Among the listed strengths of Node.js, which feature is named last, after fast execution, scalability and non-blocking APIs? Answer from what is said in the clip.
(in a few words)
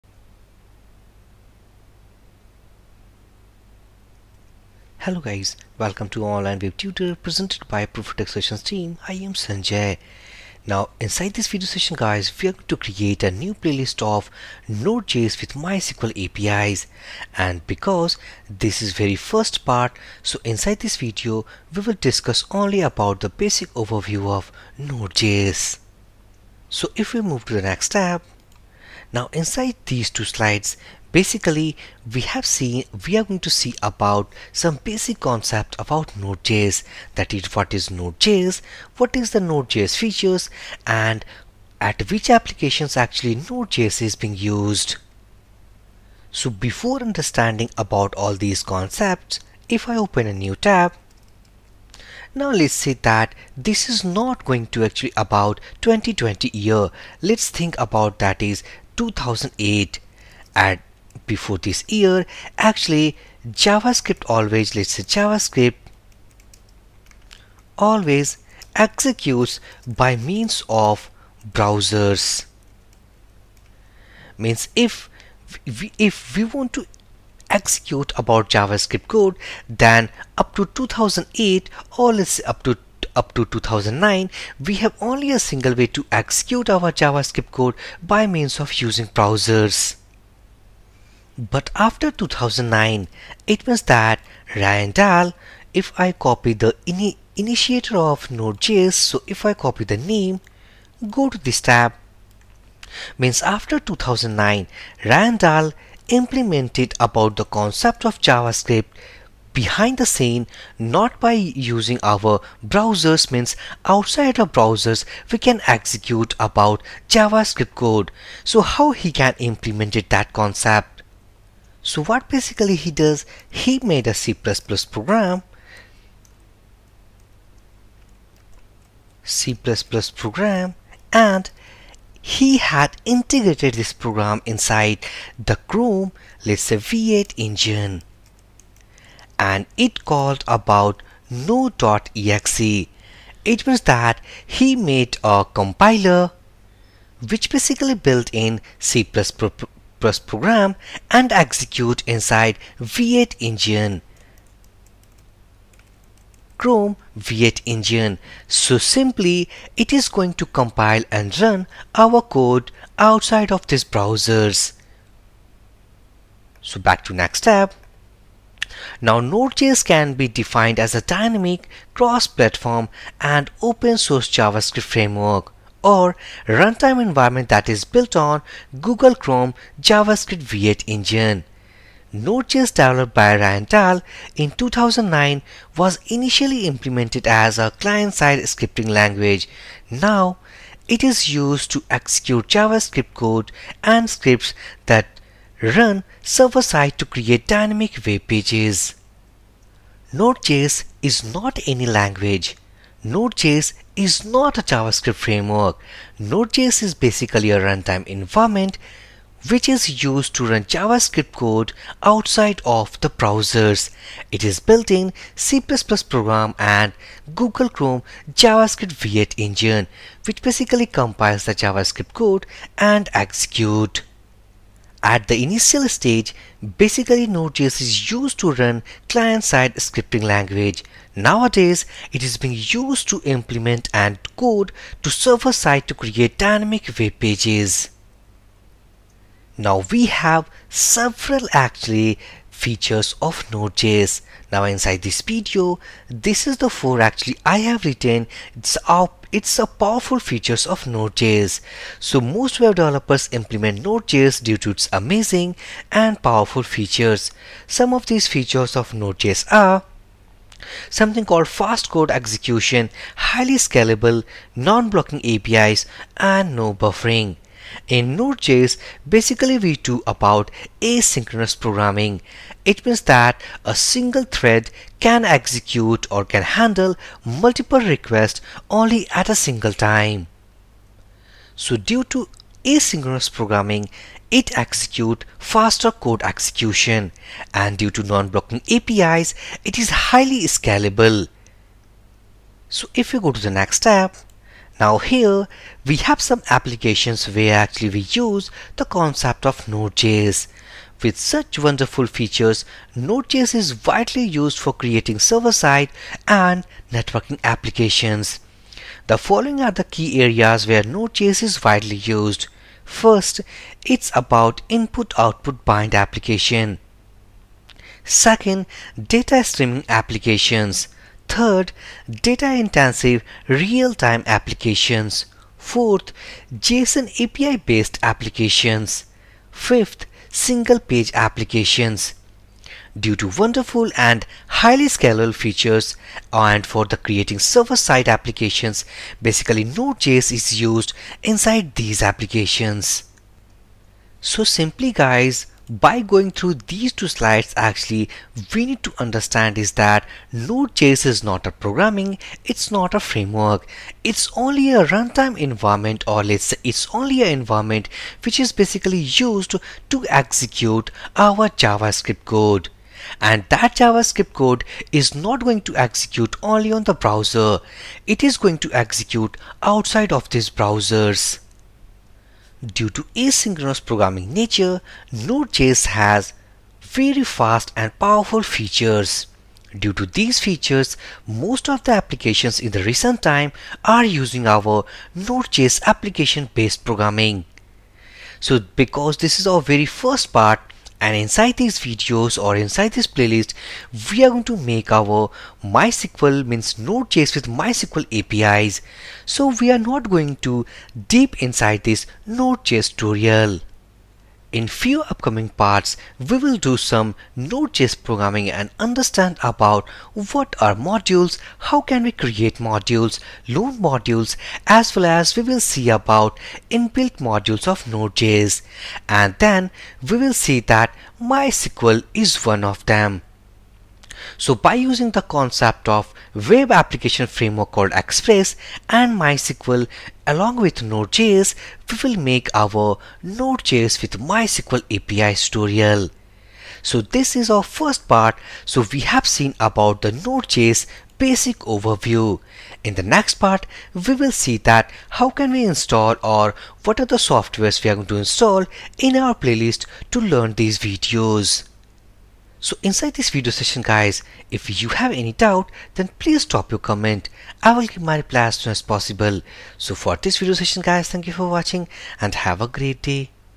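no buffering.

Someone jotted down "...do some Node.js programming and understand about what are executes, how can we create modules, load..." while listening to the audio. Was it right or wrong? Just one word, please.
wrong.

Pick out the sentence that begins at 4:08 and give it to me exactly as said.
It's a it's a powerful features of Node.js.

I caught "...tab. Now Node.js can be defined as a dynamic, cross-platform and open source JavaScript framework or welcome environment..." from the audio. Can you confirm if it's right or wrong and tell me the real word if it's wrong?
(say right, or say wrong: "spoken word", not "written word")
wrong: "runtime", not "welcome".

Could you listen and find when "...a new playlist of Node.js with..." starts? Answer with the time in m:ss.
0:13.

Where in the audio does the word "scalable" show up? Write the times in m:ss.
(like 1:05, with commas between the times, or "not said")
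4:23, 4:50, 5:34.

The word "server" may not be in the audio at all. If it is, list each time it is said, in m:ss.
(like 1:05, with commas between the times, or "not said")
3:16, 3:55, 5:05, 5:37.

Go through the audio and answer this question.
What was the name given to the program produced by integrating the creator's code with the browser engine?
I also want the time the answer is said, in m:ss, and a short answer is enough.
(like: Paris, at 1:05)
Node.exe, at 2:21.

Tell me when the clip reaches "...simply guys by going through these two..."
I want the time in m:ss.
5:44.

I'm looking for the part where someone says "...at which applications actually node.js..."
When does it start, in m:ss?
0:41.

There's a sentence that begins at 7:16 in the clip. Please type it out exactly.
So this is our first part.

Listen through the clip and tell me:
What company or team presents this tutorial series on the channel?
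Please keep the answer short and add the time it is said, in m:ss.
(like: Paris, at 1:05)
Profitex Sessions, at 0:07.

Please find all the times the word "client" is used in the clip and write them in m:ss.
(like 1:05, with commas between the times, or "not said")
3:07, 3:49.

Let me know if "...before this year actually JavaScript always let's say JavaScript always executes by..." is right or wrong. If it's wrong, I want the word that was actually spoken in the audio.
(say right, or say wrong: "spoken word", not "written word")
right.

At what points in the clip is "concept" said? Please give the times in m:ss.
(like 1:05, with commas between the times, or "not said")
0:35, 0:48, 1:47, 2:00, 4:58, 7:05.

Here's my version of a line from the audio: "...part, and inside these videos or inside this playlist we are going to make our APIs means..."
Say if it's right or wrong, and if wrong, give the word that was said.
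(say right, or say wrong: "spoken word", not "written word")
wrong: "MySQL", not "APIs".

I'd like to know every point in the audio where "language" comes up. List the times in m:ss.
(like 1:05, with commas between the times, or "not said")
3:08, 3:21, 3:50.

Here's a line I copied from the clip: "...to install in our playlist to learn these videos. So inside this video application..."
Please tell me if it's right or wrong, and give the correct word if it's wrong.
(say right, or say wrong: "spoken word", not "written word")
wrong: "session", not "application".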